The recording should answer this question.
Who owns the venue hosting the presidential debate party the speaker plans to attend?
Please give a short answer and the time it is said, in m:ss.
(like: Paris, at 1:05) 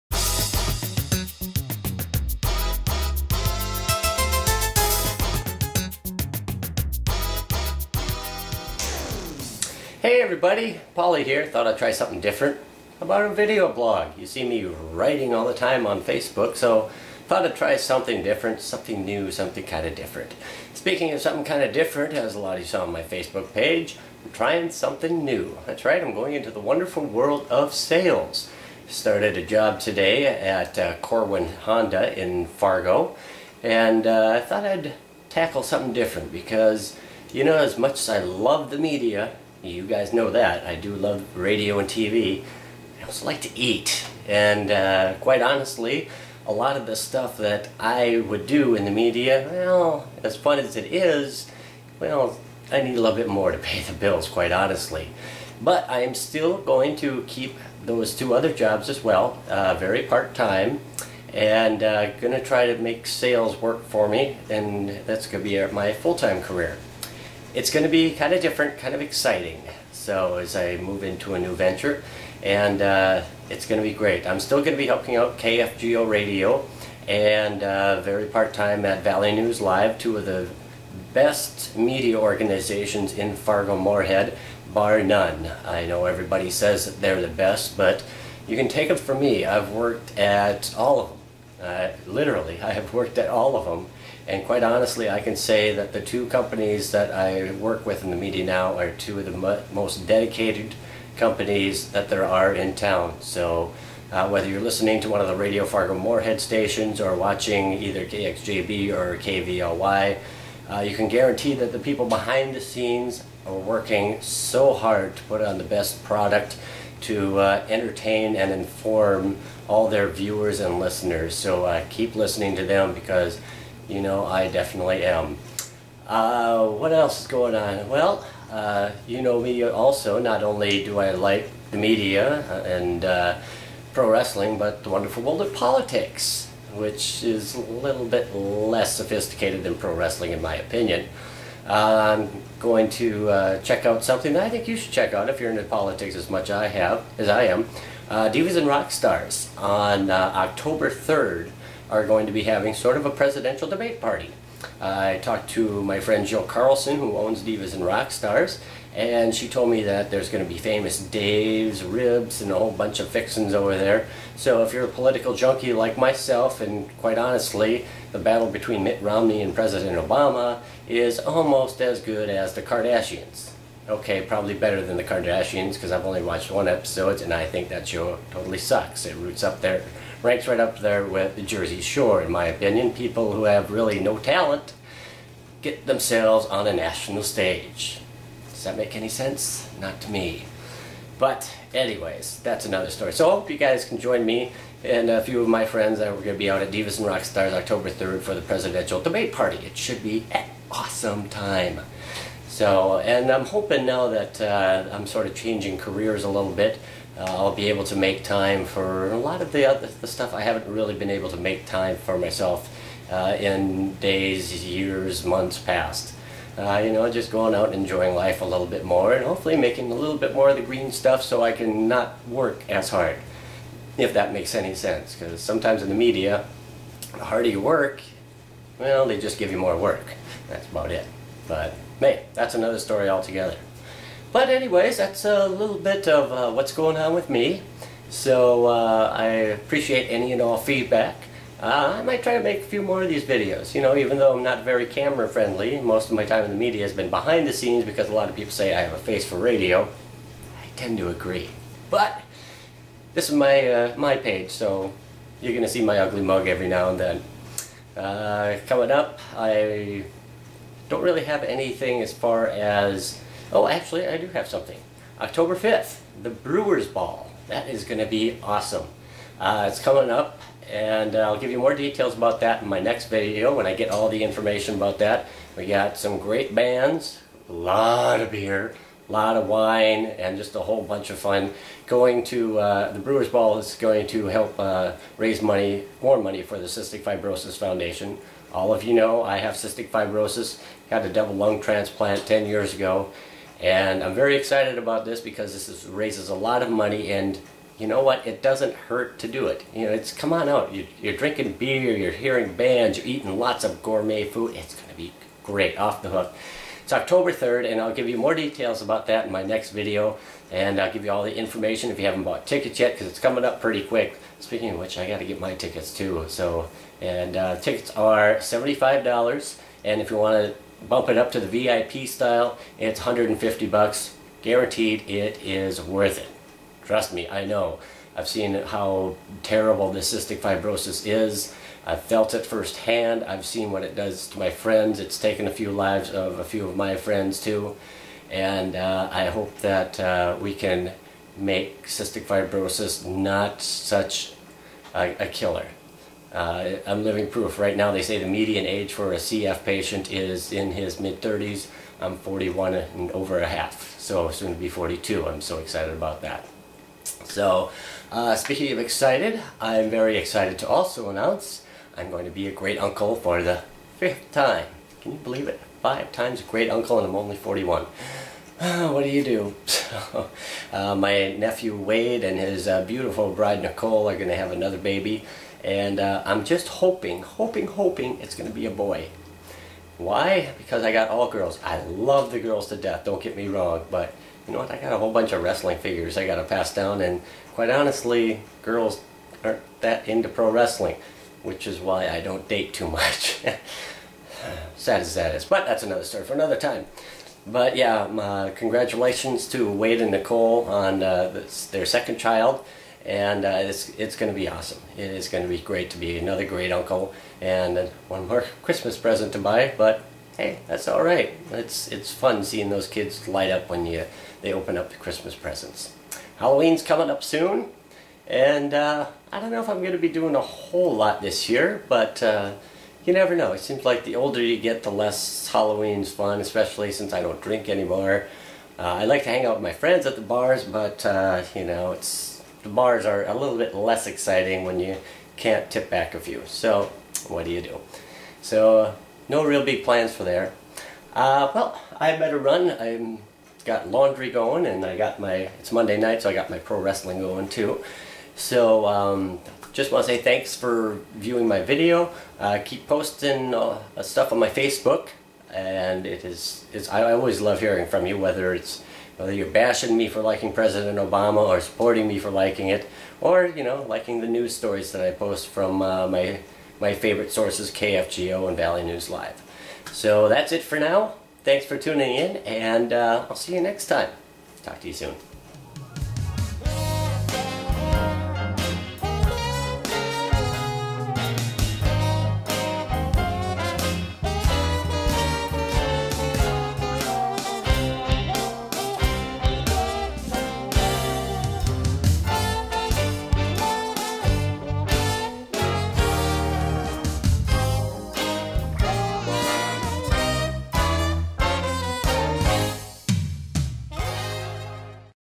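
Jill Carlson, at 2:36.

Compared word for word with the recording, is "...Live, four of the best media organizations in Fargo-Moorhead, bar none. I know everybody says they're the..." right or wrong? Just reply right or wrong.
wrong.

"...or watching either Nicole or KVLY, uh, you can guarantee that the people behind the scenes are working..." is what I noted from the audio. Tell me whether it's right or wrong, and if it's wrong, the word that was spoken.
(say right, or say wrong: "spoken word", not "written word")
wrong: "KXJB", not "Nicole".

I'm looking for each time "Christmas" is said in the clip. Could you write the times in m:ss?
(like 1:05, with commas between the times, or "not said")
6:48, 6:54.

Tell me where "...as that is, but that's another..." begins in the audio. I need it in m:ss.
6:35.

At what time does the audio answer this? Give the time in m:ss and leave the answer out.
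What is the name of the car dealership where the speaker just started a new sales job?
0:30.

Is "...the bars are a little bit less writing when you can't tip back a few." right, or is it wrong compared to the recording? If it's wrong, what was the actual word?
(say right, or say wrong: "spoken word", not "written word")
wrong: "exciting", not "writing".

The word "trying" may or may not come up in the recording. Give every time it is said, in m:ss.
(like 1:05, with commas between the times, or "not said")
0:24.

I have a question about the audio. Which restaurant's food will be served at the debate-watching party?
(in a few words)
Famous Dave's.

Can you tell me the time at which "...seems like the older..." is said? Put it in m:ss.
7:03.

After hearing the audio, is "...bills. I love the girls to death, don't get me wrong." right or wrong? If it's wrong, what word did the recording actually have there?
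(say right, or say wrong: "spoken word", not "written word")
wrong: "girls", not "bills".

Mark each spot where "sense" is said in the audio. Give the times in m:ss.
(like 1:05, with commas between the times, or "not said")
3:09, 3:44.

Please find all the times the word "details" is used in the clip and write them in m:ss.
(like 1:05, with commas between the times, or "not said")
4:31, 5:08.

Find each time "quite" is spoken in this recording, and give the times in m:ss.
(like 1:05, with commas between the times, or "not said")
0:45, 0:54, 1:34, 2:46, 6:27.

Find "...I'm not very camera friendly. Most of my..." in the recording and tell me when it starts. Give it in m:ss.
4:04.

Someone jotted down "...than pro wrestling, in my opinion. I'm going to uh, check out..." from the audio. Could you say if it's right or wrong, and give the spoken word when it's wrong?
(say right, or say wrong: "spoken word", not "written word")
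right.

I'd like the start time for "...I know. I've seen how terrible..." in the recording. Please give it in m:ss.
5:27.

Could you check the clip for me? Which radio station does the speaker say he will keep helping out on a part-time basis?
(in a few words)
KFGO Radio.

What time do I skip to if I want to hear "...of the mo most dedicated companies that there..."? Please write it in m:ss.
1:39.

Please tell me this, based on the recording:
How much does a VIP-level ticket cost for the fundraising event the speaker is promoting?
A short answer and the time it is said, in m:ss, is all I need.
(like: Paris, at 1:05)
$150, at 5:22.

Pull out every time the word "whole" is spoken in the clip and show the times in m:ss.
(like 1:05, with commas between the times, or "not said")
2:42, 4:40, 6:24, 7:00.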